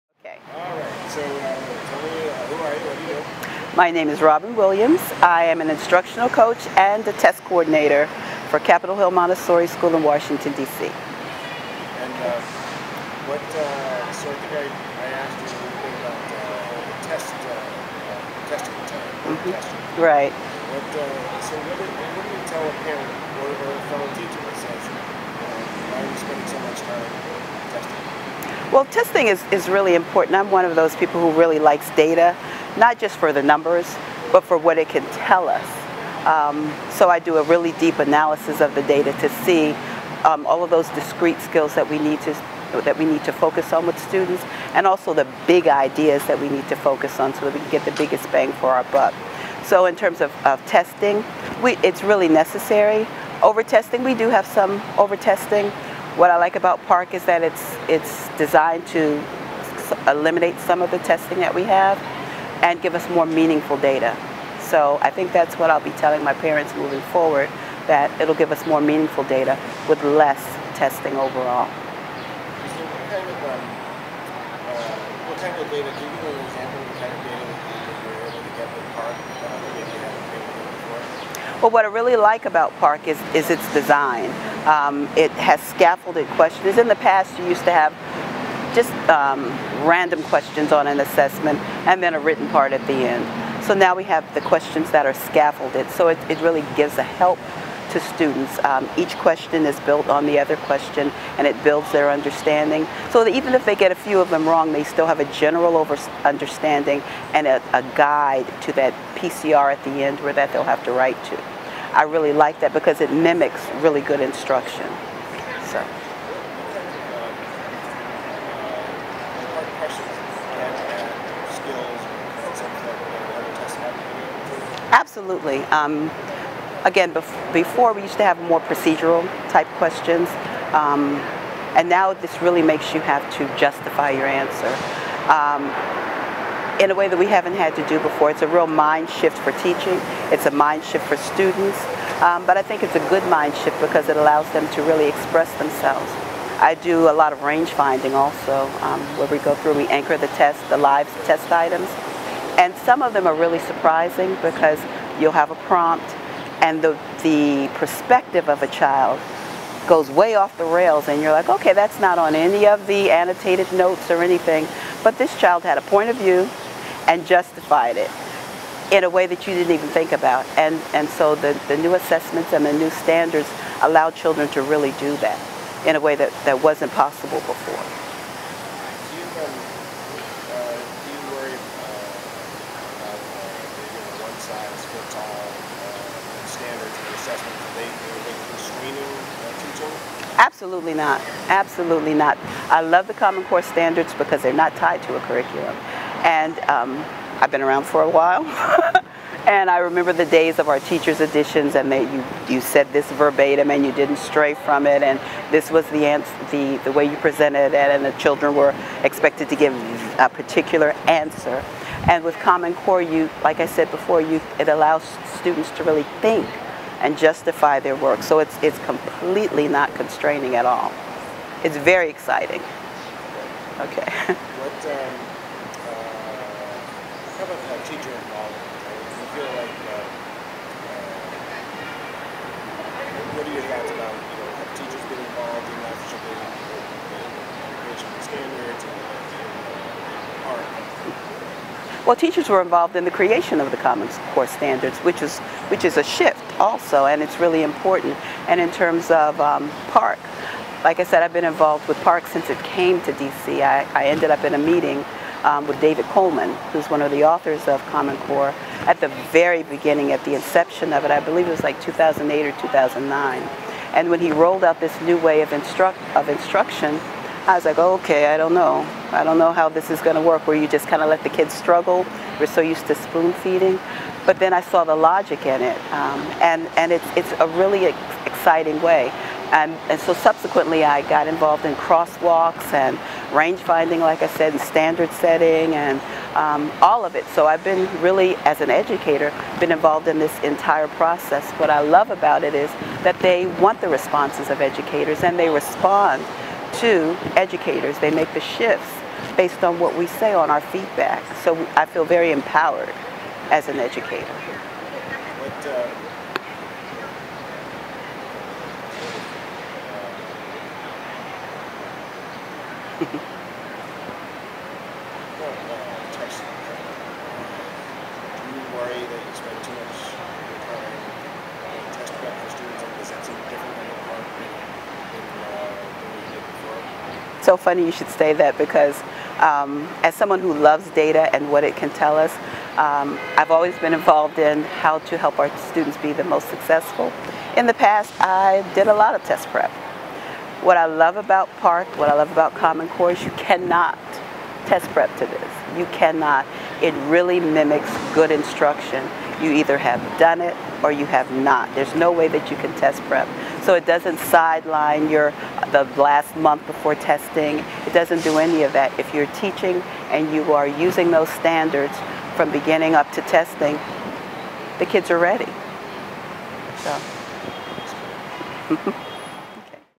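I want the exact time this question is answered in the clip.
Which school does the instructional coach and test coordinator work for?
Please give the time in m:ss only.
0:08.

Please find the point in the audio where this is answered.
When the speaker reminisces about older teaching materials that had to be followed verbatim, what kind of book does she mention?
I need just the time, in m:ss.
3:20.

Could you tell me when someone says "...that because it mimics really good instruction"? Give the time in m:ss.
1:52.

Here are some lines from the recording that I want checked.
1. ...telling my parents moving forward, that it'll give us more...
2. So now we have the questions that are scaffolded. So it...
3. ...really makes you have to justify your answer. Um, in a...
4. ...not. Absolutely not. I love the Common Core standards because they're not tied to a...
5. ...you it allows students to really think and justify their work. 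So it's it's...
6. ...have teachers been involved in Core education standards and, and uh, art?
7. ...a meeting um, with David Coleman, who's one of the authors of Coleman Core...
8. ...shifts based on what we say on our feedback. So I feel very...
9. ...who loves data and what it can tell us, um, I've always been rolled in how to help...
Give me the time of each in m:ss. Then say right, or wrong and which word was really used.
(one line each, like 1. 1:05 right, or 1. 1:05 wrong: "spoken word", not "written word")
1. 1:05 right
2. 1:33 right
3. 2:12 right
4. 3:10 right
5. 3:34 right
6. 3:54 wrong: "African", not "Core"
7. 4:14 wrong: "Common", not "Coleman"
8. 4:58 right
9. 5:30 wrong: "involved", not "rolled".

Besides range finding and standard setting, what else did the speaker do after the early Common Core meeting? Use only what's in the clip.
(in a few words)
crosswalks.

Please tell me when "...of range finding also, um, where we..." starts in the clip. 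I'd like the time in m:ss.
2:27.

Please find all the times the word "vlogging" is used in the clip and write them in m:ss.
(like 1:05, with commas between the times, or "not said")
not said.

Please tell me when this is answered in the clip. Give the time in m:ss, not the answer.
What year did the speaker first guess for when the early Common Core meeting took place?
4:21.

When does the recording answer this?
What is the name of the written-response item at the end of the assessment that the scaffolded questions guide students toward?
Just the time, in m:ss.
1:49.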